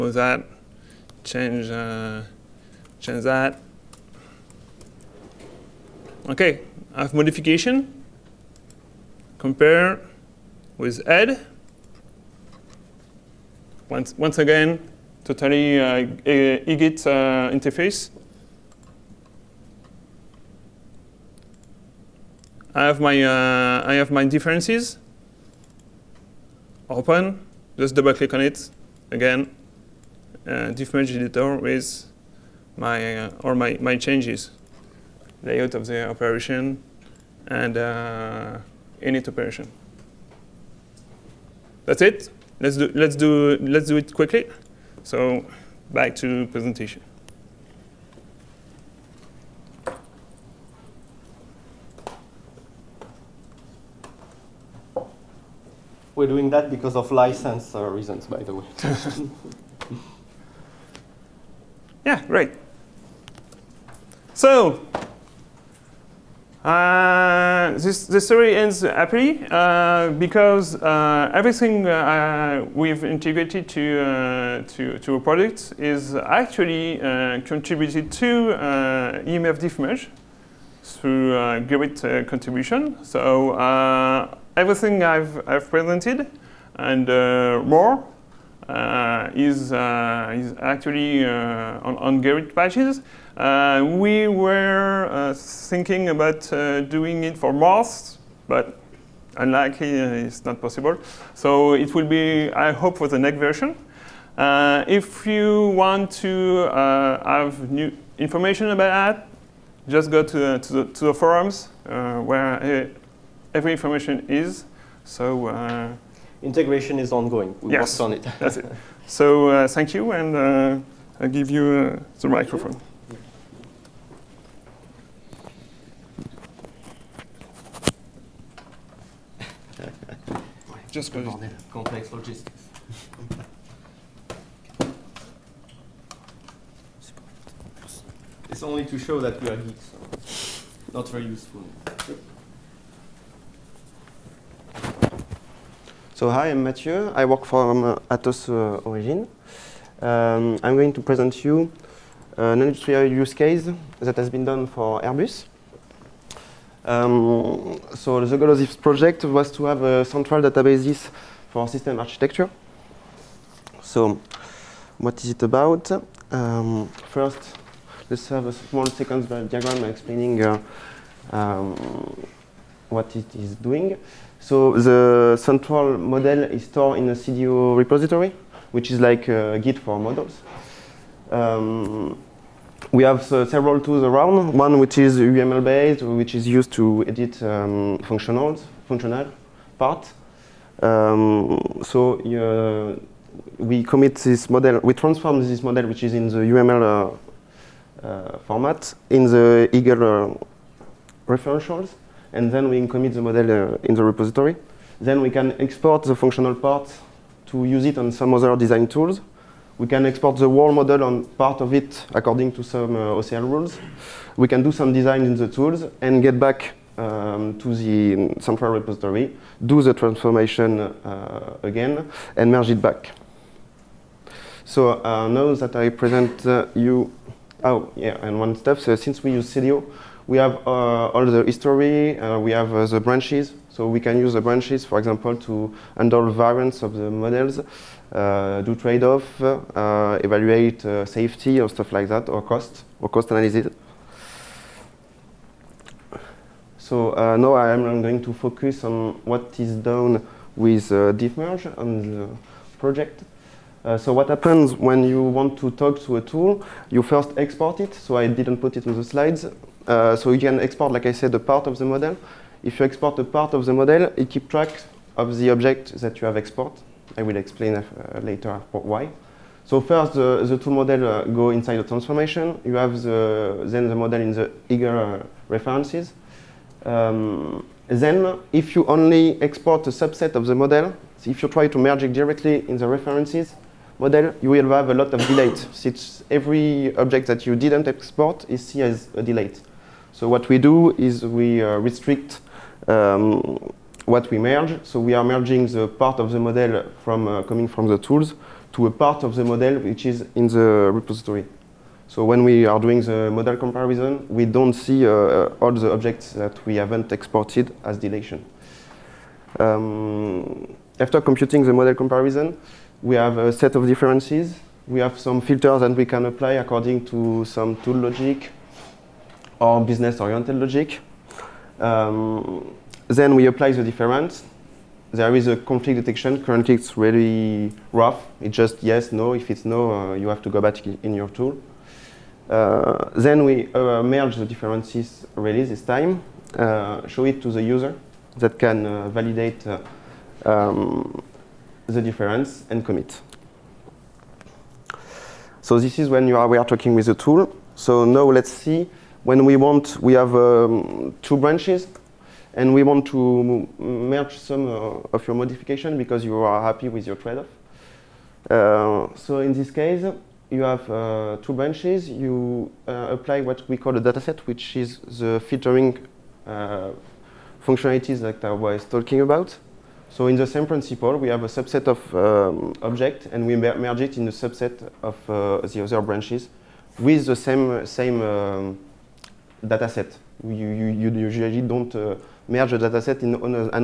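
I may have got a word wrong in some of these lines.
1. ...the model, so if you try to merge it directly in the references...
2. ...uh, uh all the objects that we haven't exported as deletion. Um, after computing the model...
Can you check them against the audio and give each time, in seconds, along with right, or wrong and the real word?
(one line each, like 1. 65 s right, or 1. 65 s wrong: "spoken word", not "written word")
1. 280 s right
2. 305 s right.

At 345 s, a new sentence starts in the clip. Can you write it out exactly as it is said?
So this is when you are, we are talking with the tool.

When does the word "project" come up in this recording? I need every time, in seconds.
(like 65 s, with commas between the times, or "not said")
158 s, 252 s.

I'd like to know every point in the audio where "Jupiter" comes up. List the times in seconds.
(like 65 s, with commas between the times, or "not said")
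not said.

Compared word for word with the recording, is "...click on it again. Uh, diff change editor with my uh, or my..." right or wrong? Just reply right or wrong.
wrong.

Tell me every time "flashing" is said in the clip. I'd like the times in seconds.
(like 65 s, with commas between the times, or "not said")
not said.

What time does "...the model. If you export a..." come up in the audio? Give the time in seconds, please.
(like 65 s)
261 s.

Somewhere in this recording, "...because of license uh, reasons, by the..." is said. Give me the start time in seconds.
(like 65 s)
56 s.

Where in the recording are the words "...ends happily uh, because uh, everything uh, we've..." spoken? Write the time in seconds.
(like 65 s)
68 s.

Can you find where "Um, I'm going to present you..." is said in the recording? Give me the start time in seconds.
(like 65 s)
150 s.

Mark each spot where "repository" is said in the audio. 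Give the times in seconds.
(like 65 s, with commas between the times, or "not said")
177 s, 204 s, 218 s, 300 s.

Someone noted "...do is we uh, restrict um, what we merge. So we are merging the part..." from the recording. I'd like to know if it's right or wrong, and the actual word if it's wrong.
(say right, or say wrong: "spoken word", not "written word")
right.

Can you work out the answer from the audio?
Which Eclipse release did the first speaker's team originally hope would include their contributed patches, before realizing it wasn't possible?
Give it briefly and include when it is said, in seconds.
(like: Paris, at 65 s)
Mars, at 97 s.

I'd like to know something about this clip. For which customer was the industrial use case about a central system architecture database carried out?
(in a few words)
Airbus.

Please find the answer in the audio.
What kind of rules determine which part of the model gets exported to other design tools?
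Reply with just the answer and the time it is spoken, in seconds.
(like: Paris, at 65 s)
OCL rules, at 213 s.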